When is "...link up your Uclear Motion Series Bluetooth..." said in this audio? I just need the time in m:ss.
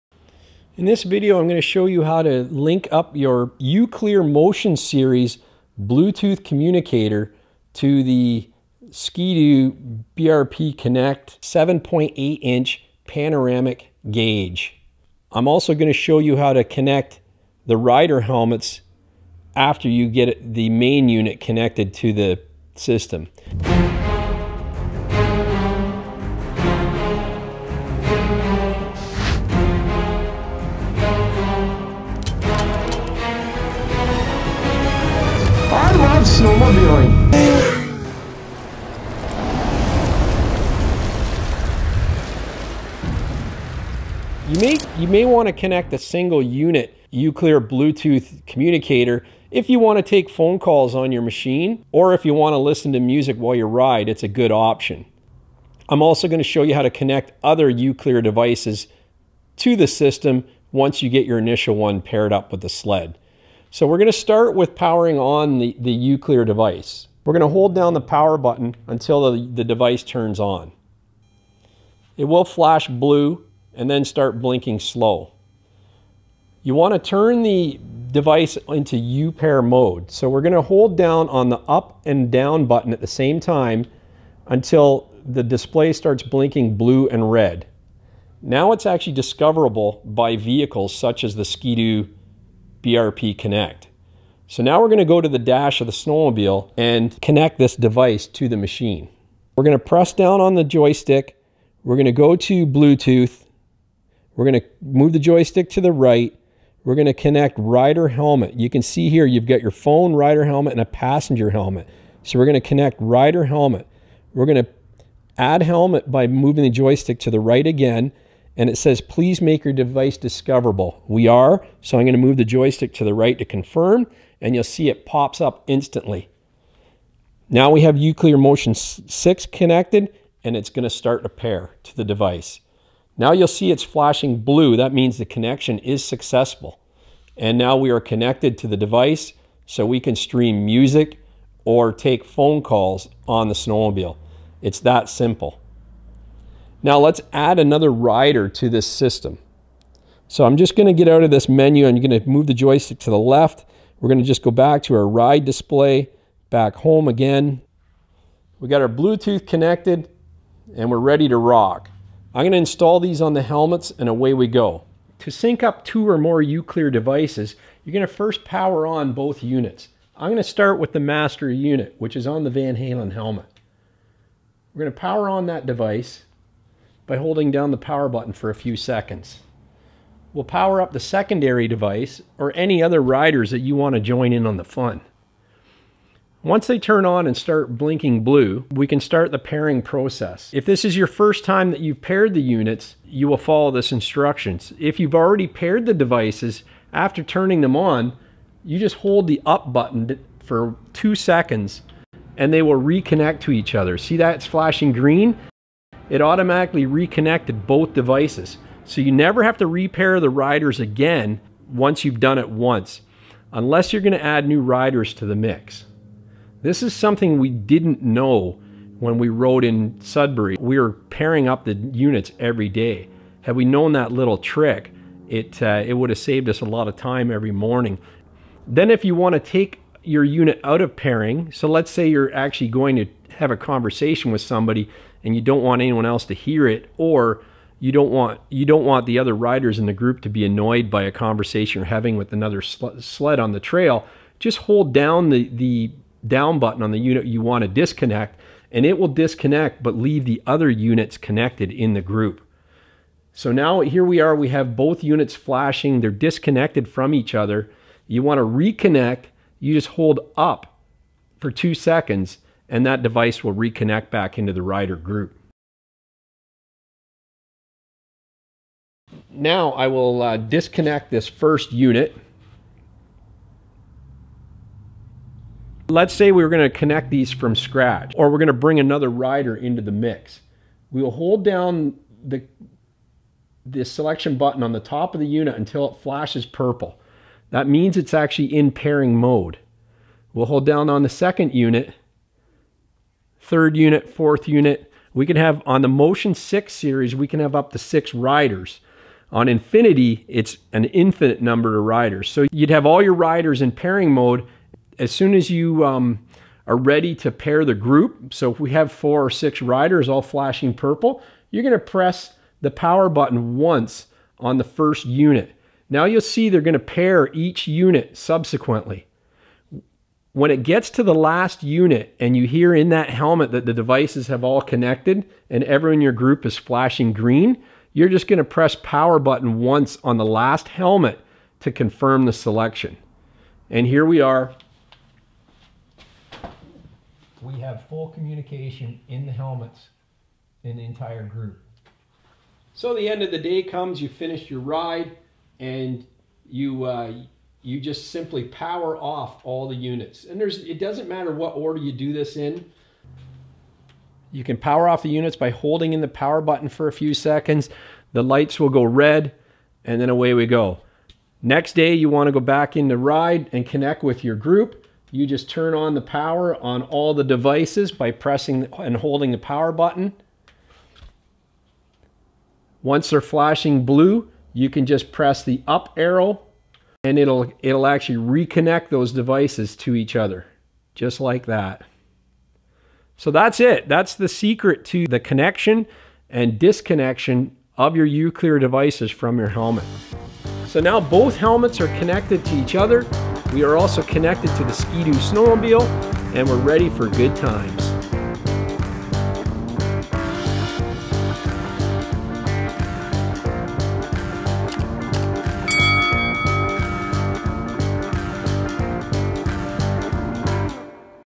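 0:02.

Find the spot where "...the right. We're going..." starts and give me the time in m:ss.
1:45.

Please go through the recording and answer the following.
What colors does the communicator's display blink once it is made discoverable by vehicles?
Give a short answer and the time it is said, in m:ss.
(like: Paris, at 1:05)
Blue and red, at 1:26.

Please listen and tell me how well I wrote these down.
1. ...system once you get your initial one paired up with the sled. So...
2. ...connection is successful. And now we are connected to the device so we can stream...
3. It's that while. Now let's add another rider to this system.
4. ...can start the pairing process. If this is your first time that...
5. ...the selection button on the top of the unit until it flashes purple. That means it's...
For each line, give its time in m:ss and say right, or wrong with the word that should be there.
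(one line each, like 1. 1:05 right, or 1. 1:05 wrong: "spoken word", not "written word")
1. 0:59 right
2. 2:15 right
3. 2:24 wrong: "simple", not "while"
4. 3:08 right
5. 4:43 right.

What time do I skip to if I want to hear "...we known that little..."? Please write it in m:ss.
3:43.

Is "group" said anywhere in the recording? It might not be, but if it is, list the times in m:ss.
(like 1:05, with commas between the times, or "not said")
3:59, 4:12, 4:24, 5:07, 5:26, 5:41, 6:04.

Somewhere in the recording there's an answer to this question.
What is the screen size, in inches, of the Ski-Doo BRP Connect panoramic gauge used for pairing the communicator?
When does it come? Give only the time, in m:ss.
0:11.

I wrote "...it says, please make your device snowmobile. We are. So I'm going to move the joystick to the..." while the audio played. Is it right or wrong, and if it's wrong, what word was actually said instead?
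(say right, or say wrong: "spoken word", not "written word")
wrong: "discoverable", not "snowmobile".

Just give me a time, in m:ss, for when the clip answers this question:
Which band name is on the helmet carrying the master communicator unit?
2:52.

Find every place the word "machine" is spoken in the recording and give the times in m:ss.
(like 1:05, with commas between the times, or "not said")
0:51, 1:38.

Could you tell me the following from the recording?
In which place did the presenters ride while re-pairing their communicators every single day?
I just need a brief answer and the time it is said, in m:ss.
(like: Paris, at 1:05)
Sudbury, at 3:39.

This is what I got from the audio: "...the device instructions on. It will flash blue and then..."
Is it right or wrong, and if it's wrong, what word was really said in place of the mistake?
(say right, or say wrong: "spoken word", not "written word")
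wrong: "turns", not "instructions".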